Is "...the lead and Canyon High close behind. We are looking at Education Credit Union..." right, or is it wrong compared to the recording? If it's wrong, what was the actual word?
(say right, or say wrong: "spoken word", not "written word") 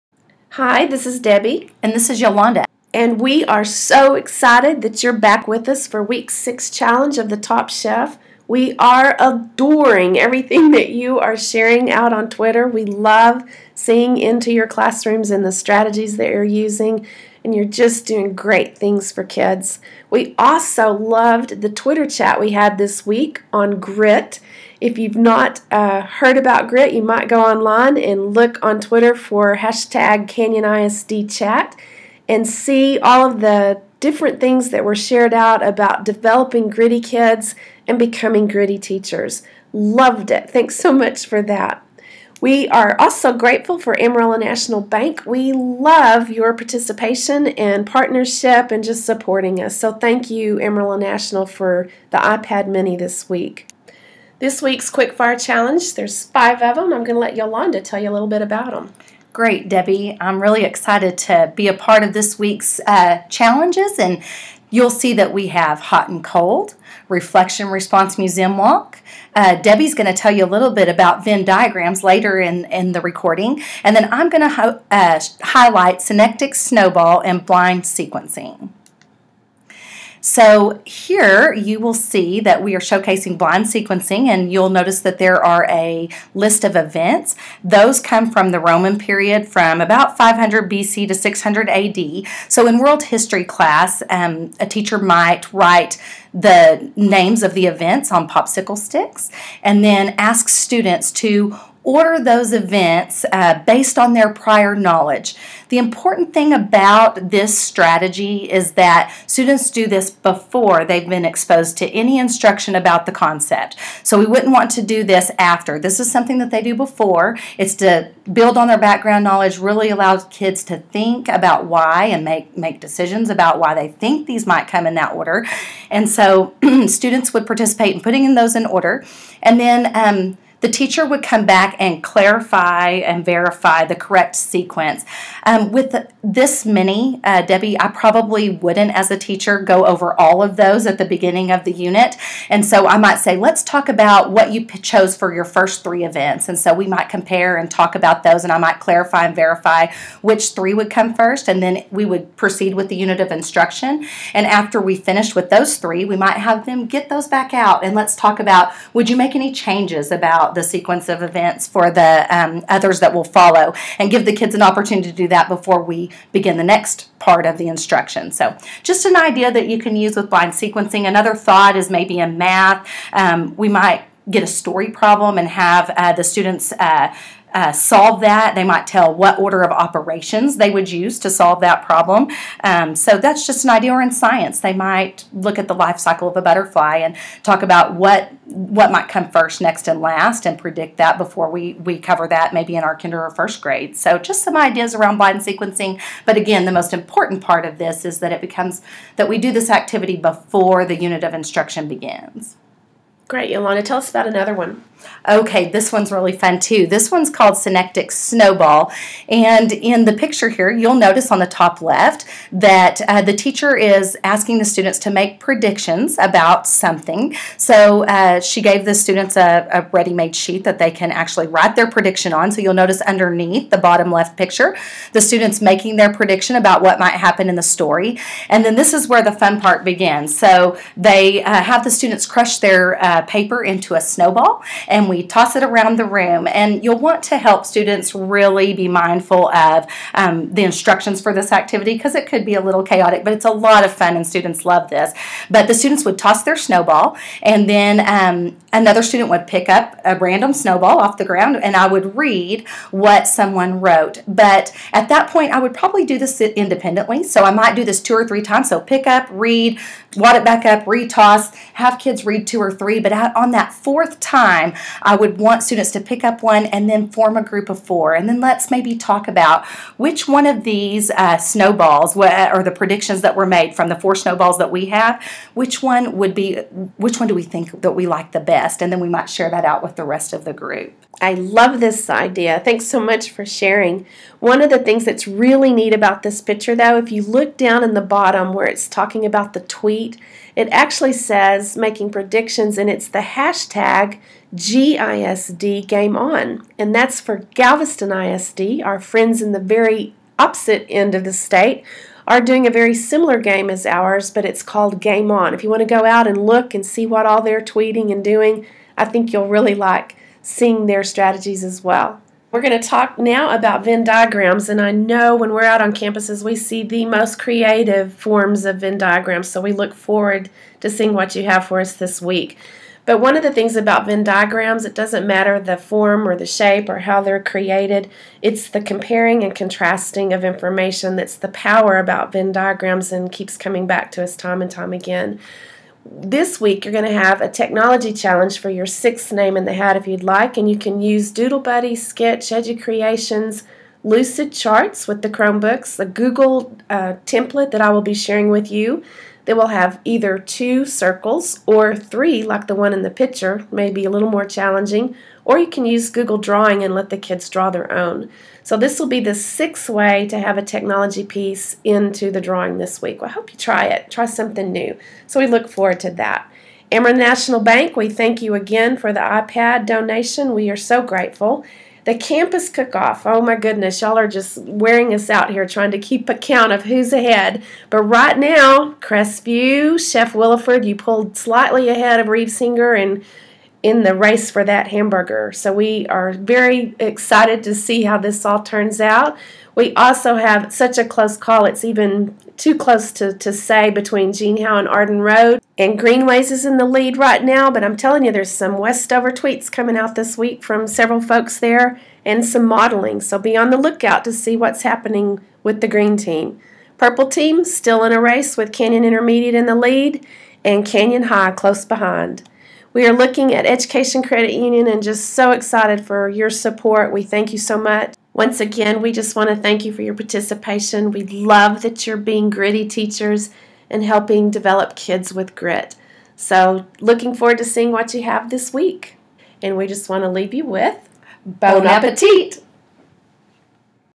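right.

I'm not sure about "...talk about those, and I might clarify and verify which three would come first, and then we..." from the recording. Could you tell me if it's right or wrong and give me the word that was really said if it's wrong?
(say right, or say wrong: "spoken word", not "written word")
right.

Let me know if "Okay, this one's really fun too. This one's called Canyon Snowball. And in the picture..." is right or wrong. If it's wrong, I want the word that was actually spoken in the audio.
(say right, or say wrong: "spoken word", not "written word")
wrong: "Synectic", not "Canyon".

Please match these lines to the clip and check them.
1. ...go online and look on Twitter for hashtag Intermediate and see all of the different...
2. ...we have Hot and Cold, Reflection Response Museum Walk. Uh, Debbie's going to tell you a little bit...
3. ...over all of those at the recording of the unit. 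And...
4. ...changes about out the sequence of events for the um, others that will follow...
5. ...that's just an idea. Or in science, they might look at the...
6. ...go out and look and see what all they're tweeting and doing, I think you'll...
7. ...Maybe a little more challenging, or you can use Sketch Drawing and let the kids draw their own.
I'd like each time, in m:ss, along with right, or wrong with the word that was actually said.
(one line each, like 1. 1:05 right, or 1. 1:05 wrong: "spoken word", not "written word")
1. 0:27 wrong: "CanyonISDChat", not "Intermediate"
2. 1:05 right
3. 2:19 wrong: "beginning", not "recording"
4. 2:39 right
5. 3:03 right
6. 5:05 right
7. 5:53 wrong: "Google", not "Sketch".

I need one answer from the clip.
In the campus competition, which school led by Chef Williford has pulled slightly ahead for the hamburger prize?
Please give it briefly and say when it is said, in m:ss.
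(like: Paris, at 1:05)
Crestview, at 6:18.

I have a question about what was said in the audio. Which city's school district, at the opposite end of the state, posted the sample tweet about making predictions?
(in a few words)
Galveston.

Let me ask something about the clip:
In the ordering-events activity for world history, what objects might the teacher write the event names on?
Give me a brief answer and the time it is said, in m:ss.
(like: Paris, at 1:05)
popsicle sticks, at 1:38.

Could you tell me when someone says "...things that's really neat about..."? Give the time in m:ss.
4:44.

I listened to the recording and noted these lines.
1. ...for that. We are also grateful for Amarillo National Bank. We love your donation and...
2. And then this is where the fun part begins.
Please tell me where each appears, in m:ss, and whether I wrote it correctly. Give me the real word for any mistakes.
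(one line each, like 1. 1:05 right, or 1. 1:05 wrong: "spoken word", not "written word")
1. 0:41 wrong: "participation", not "donation"
2. 3:48 right.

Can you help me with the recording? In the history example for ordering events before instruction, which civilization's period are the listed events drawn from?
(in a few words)
Roman.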